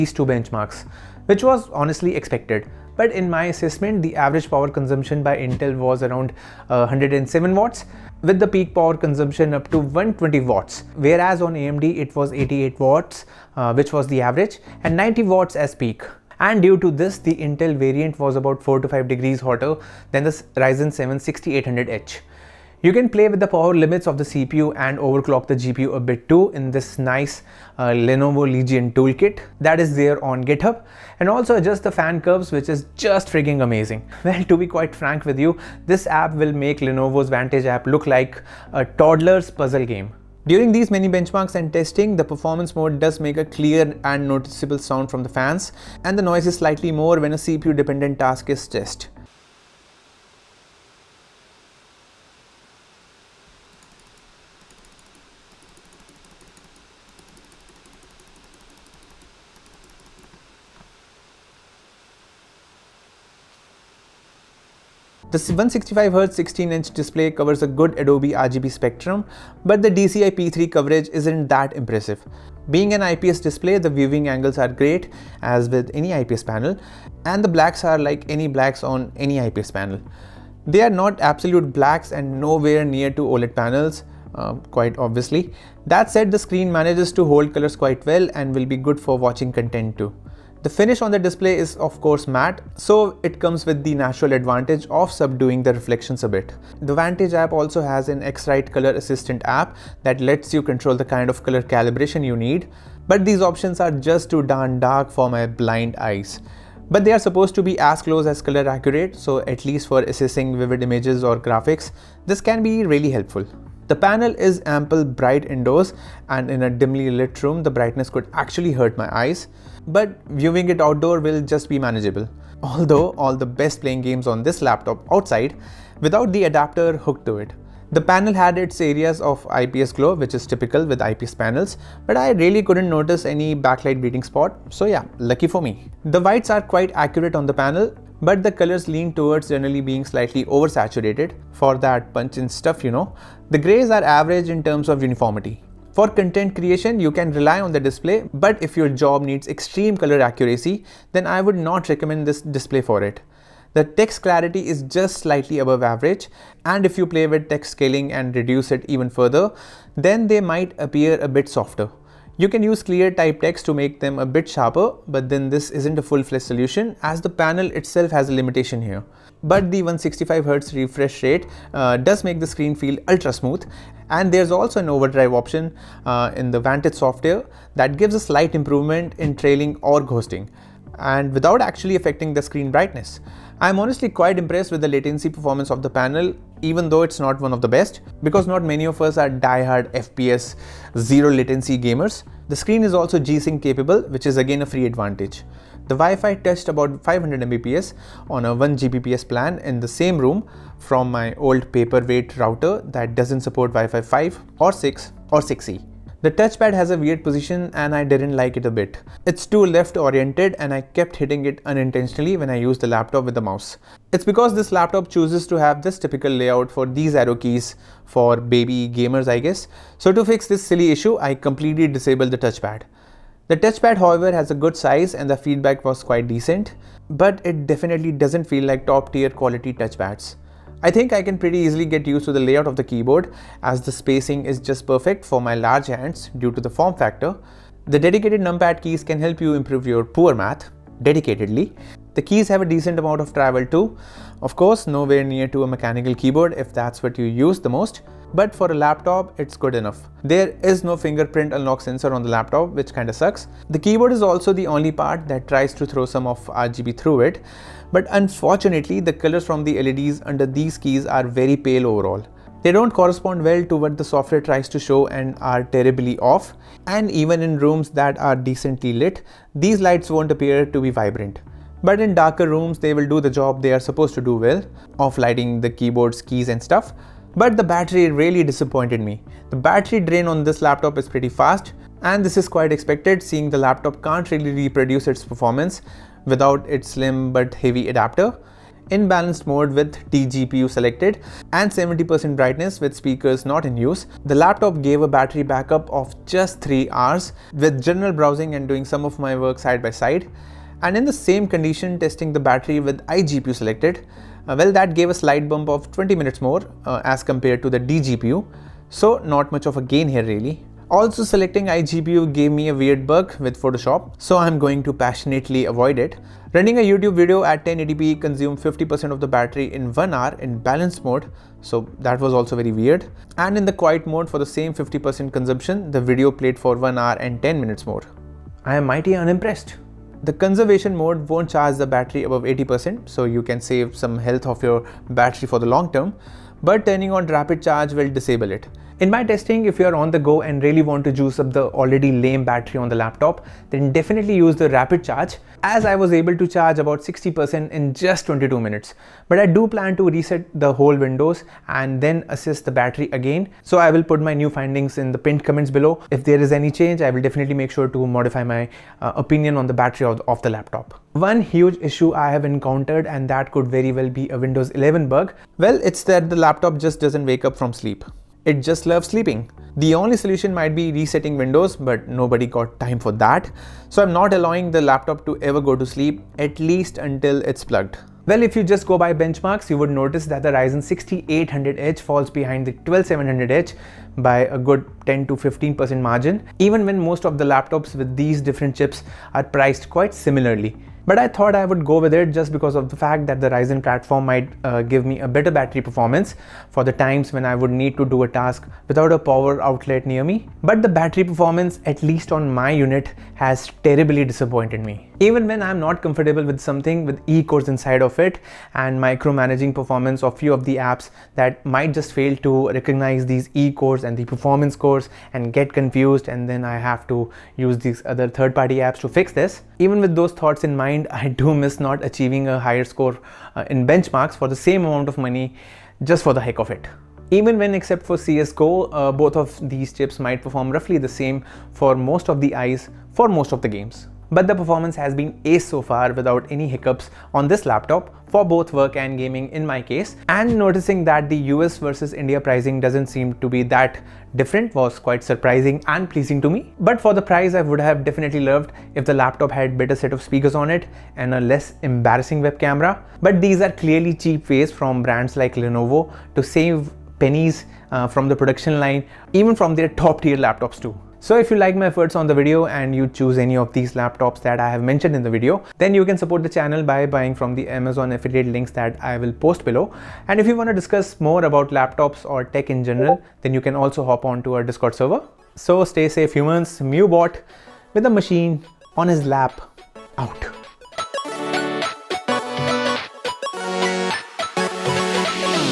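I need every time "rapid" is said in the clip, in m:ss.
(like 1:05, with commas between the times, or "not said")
5:37, 5:44.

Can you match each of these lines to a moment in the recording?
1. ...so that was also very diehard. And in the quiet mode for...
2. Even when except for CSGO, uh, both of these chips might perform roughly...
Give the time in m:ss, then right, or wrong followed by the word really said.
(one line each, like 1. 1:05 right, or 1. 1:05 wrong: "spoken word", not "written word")
1. 5:21 wrong: "weird", not "diehard"
2. 7:07 right.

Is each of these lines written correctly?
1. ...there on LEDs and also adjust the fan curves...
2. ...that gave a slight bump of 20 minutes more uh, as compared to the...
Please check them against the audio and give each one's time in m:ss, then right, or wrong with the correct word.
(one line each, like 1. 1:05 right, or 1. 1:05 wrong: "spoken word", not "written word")
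1. 0:29 wrong: "GitHub", not "LEDs"
2. 5:04 right.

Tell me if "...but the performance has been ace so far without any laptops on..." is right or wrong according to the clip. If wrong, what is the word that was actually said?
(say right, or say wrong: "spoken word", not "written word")
wrong: "hiccups", not "laptops".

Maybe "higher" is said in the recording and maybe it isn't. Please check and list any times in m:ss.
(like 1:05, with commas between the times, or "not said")
7:02.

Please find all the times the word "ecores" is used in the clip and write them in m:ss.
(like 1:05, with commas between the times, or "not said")
6:47, 6:53.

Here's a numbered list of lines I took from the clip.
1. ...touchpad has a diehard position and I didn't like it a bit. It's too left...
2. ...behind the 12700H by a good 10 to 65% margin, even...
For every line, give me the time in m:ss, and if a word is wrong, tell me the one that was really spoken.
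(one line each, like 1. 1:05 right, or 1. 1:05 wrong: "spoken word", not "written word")
1. 3:26 wrong: "weird", not "diehard"
2. 6:22 wrong: "15", not "65".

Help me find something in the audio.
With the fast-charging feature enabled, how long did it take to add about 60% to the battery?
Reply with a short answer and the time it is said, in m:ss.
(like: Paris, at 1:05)
22 minutes, at 5:48.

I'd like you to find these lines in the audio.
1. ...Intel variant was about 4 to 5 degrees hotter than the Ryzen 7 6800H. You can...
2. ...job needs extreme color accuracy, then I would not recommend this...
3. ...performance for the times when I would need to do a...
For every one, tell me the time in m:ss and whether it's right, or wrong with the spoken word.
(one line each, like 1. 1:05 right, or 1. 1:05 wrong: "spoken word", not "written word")
1. 0:17 right
2. 2:28 right
3. 6:35 right.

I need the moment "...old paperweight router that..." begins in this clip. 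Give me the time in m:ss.
3:21.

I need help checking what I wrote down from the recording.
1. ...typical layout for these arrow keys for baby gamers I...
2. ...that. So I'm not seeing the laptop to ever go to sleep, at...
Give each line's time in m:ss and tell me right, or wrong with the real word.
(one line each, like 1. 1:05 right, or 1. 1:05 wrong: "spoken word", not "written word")
1. 3:35 right
2. 6:13 wrong: "allowing", not "seeing".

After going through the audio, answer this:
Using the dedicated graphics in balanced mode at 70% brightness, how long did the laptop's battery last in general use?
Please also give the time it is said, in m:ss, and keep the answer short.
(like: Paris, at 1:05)
3 hours, at 4:56.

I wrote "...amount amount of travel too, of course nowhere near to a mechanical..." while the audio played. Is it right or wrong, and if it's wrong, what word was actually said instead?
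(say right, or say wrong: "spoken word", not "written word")
wrong: "decent", not "amount".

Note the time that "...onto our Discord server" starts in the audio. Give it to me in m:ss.
7:54.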